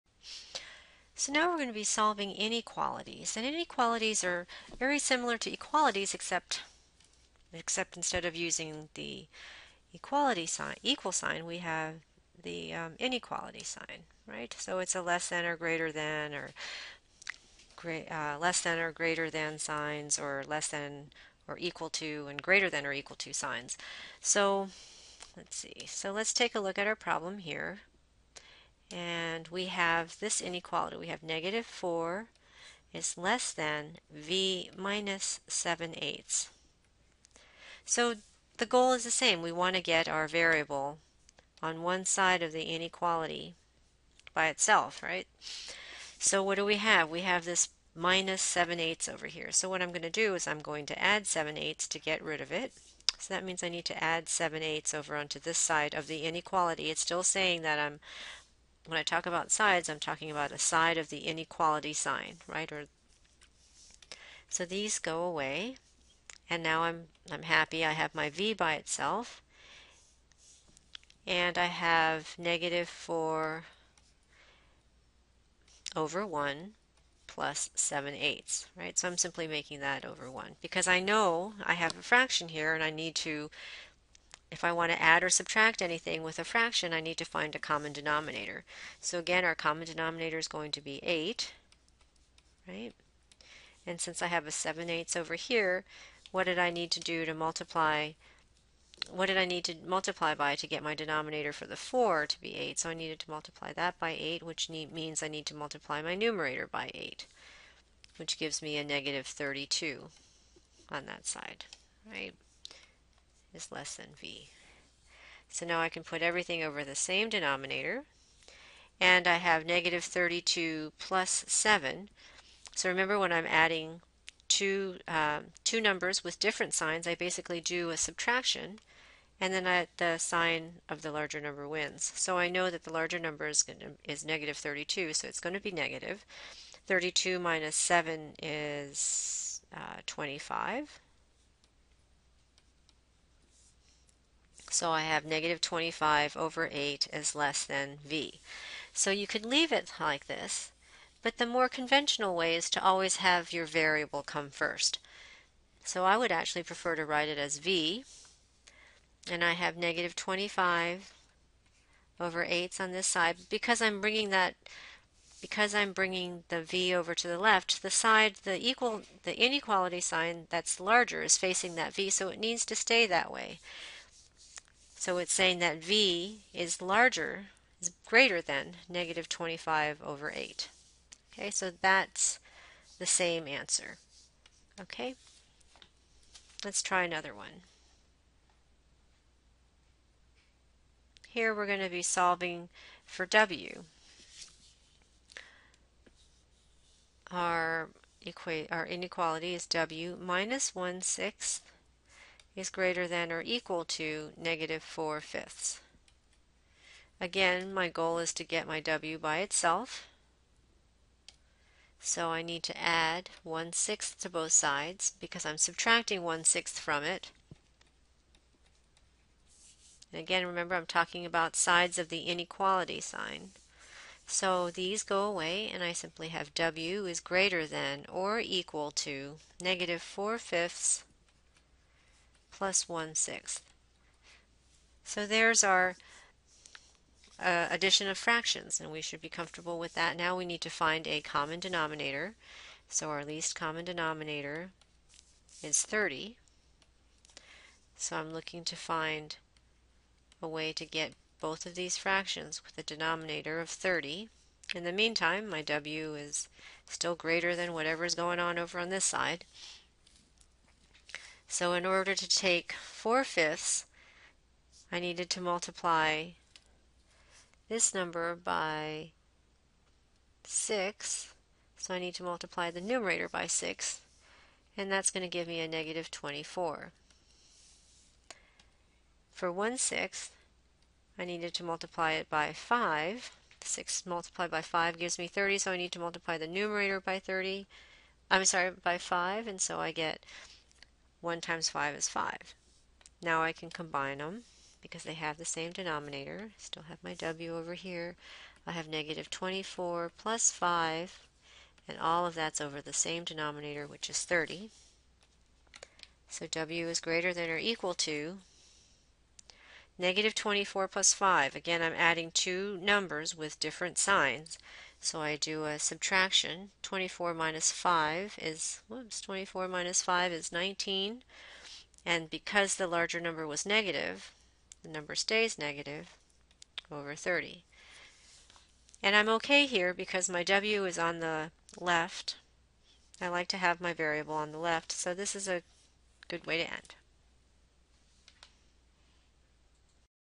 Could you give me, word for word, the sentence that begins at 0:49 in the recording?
So what I'm going to do is I'm going to add 7 eighths to get rid of it.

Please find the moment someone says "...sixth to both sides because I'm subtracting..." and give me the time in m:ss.
3:33.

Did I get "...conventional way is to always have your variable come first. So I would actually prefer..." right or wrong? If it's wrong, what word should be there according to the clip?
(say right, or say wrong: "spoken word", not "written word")
right.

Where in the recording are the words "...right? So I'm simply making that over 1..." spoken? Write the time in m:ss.
1:18.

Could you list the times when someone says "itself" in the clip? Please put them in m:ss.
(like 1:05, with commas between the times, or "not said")
0:44, 1:08, 3:29.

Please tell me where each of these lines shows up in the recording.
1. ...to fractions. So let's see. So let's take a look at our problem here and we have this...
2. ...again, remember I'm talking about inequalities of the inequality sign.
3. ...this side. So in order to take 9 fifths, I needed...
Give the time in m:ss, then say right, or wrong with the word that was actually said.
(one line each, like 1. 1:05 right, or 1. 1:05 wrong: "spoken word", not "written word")
1. 0:23 wrong: "signs", not "fractions"
2. 3:40 wrong: "sides", not "inequalities"
3. 4:18 wrong: "4", not "9".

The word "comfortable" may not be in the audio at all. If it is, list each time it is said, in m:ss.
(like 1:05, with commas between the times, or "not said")
3:59.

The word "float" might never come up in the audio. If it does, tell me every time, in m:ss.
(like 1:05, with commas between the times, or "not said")
not said.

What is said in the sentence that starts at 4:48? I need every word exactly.
I'm sorry, by 5, and so I get 1 times 5 is 5.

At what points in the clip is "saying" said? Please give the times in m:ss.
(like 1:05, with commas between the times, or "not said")
0:57, 2:55.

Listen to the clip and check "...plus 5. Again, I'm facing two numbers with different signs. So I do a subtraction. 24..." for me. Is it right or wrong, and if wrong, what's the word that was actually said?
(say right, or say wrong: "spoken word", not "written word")
wrong: "adding", not "facing".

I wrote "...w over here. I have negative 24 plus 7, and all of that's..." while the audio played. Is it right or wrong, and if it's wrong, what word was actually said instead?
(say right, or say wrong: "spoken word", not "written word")
wrong: "5", not "7".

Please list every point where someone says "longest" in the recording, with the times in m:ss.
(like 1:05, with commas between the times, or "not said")
not said.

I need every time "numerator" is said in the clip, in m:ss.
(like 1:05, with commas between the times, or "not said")
1:46, 4:32, 4:46.